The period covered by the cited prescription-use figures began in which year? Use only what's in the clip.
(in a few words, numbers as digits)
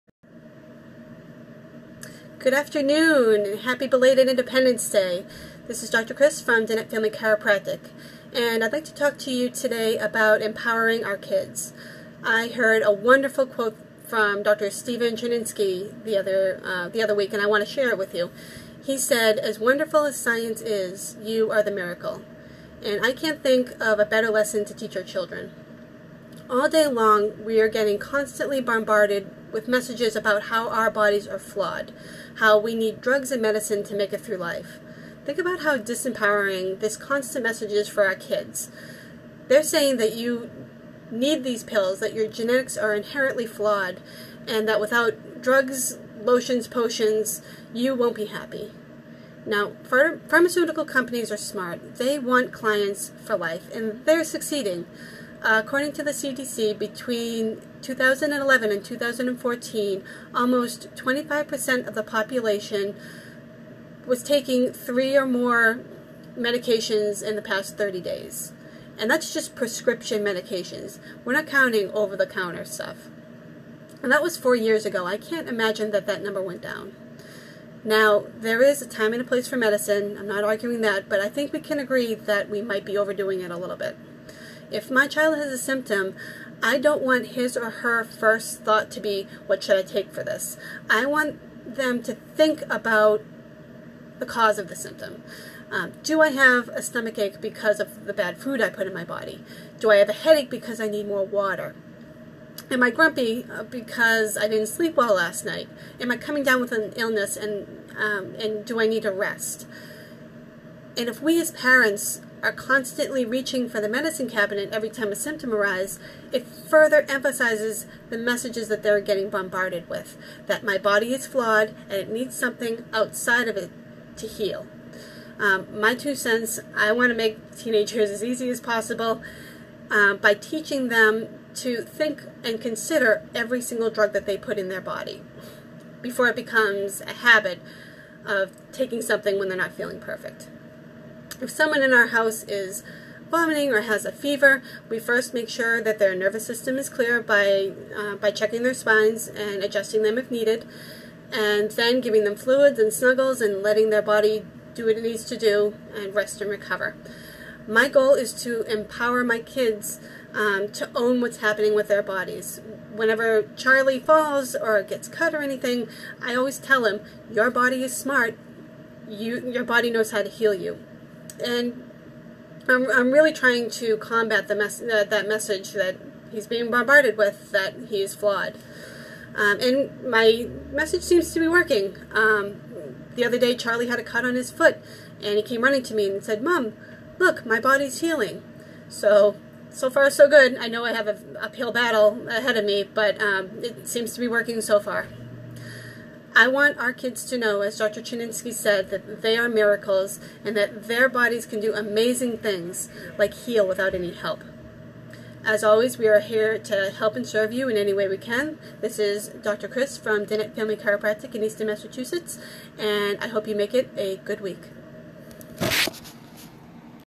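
2011.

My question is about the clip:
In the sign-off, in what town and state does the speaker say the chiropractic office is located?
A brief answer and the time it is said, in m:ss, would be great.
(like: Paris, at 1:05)
Easton, Massachusetts, at 3:31.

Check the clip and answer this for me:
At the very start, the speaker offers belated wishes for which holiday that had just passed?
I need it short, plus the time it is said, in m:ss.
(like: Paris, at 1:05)
Independence Day, at 0:04.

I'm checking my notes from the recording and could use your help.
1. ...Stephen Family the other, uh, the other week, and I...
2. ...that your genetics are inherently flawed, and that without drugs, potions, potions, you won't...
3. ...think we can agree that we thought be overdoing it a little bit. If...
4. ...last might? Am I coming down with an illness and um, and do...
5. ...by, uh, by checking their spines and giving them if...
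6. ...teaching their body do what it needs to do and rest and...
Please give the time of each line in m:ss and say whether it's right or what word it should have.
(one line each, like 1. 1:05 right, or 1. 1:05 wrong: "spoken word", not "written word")
1. 0:14 wrong: "Chernensky", not "Family"
2. 0:41 wrong: "lotions", not "potions"
3. 1:21 wrong: "might", not "thought"
4. 1:45 wrong: "night", not "might"
5. 2:27 wrong: "adjusting", not "giving"
6. 2:33 wrong: "letting", not "teaching".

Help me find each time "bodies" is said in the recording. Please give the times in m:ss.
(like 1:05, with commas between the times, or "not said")
0:30, 2:42, 3:21.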